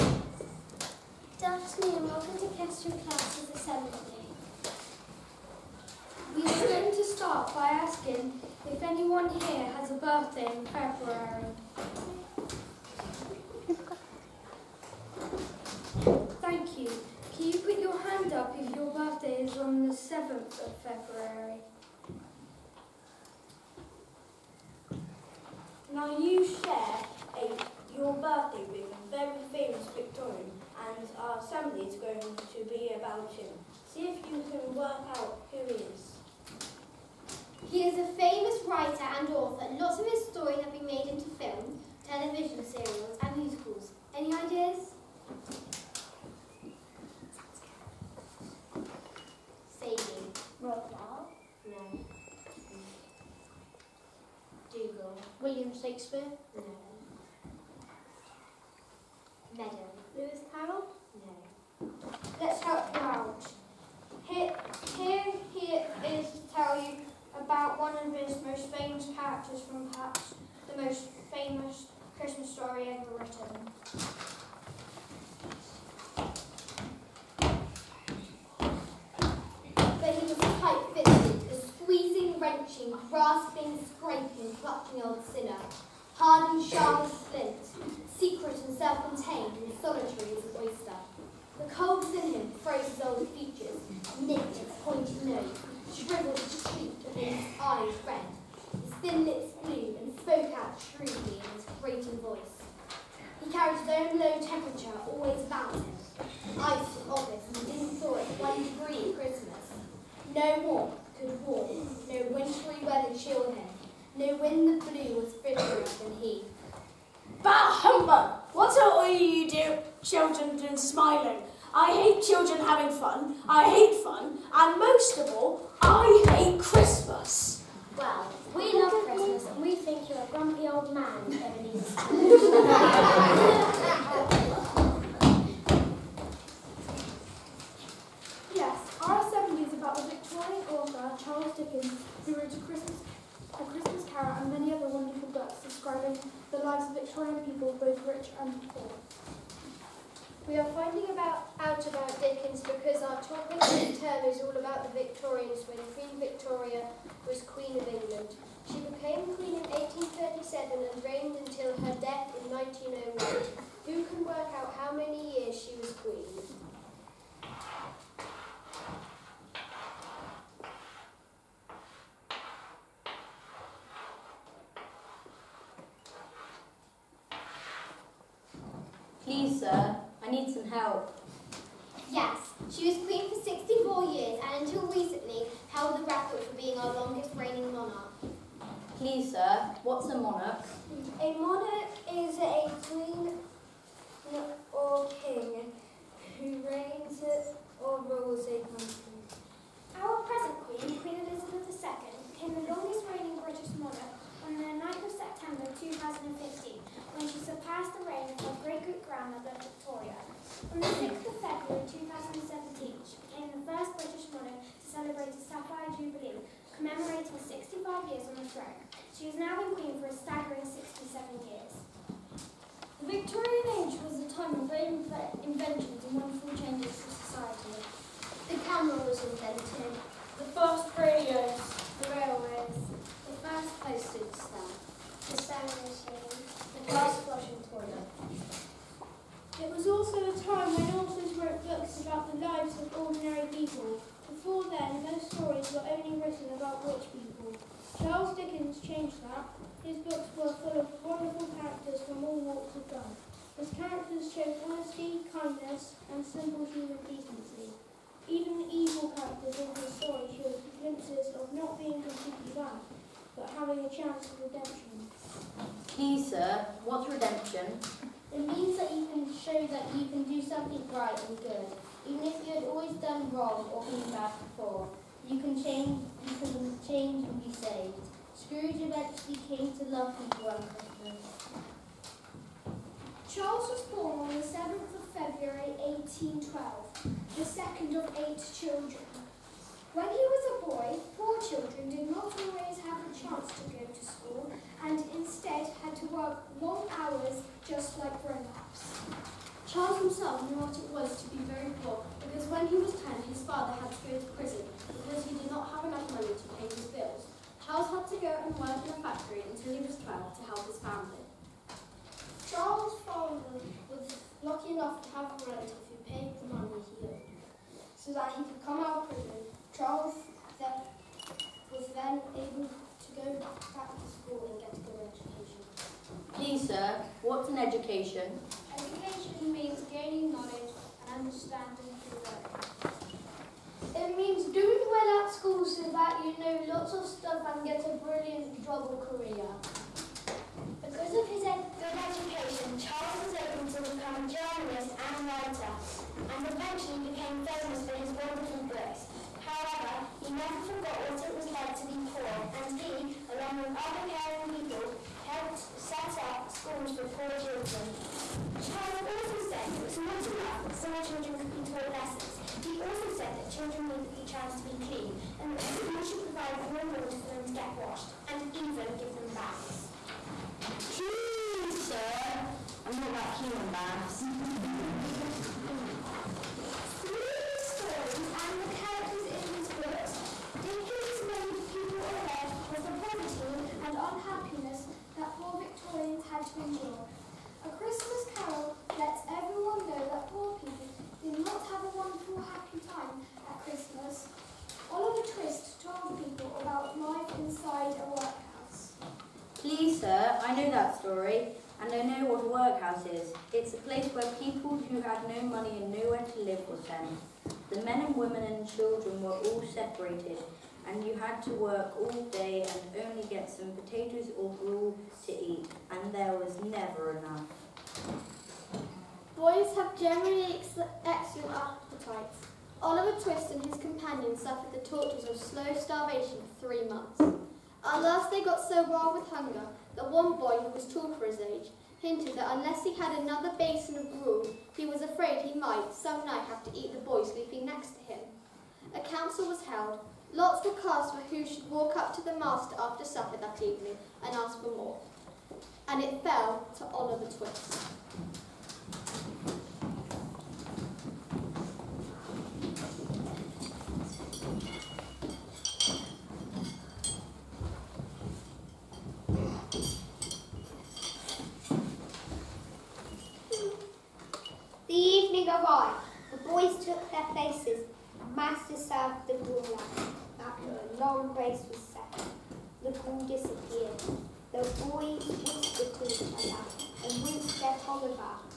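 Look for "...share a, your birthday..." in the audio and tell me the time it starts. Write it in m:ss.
0:26.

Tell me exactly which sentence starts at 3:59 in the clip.
It was also a time when authors wrote books about the lives of ordinary people.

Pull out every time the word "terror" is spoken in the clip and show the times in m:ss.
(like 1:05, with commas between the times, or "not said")
not said.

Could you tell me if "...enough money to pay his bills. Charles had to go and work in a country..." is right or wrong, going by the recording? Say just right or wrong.
wrong.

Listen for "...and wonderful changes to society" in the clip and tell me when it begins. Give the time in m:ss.
3:46.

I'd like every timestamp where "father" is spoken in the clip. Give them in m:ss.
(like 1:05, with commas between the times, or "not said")
5:03, 5:13.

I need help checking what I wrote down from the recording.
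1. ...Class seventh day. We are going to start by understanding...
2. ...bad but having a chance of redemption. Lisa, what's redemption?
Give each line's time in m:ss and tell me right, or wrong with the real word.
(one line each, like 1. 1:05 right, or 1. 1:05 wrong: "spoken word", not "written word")
1. 0:02 wrong: "asking", not "understanding"
2. 4:22 right.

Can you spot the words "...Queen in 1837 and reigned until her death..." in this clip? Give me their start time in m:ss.
2:39.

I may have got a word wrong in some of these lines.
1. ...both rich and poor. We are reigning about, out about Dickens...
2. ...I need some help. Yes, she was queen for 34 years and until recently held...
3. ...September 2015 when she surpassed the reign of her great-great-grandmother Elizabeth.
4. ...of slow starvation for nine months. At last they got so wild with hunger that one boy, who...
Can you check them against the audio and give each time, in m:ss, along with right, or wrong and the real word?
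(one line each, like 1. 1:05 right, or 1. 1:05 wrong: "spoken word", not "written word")
1. 2:27 wrong: "finding", not "reigning"
2. 3:00 wrong: "64", not "34"
3. 3:25 wrong: "Victoria", not "Elizabeth"
4. 7:05 wrong: "three", not "nine".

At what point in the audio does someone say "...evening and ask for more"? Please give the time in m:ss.
7:23.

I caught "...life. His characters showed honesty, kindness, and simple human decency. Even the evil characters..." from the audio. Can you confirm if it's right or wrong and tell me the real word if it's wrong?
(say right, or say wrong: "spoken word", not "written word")
right.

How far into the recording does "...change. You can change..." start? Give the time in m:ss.
4:35.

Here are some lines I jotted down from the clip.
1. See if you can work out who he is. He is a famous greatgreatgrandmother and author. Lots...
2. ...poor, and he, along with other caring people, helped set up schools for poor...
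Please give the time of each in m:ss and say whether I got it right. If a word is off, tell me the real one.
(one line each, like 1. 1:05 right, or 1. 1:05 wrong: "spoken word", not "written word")
1. 0:33 wrong: "writer", not "greatgreatgrandmother"
2. 5:52 right.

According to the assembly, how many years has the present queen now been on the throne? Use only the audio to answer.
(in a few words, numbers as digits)
67.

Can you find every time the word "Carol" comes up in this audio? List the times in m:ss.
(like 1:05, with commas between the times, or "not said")
2:24, 6:28.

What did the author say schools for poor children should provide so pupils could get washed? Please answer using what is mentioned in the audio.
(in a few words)
warm water.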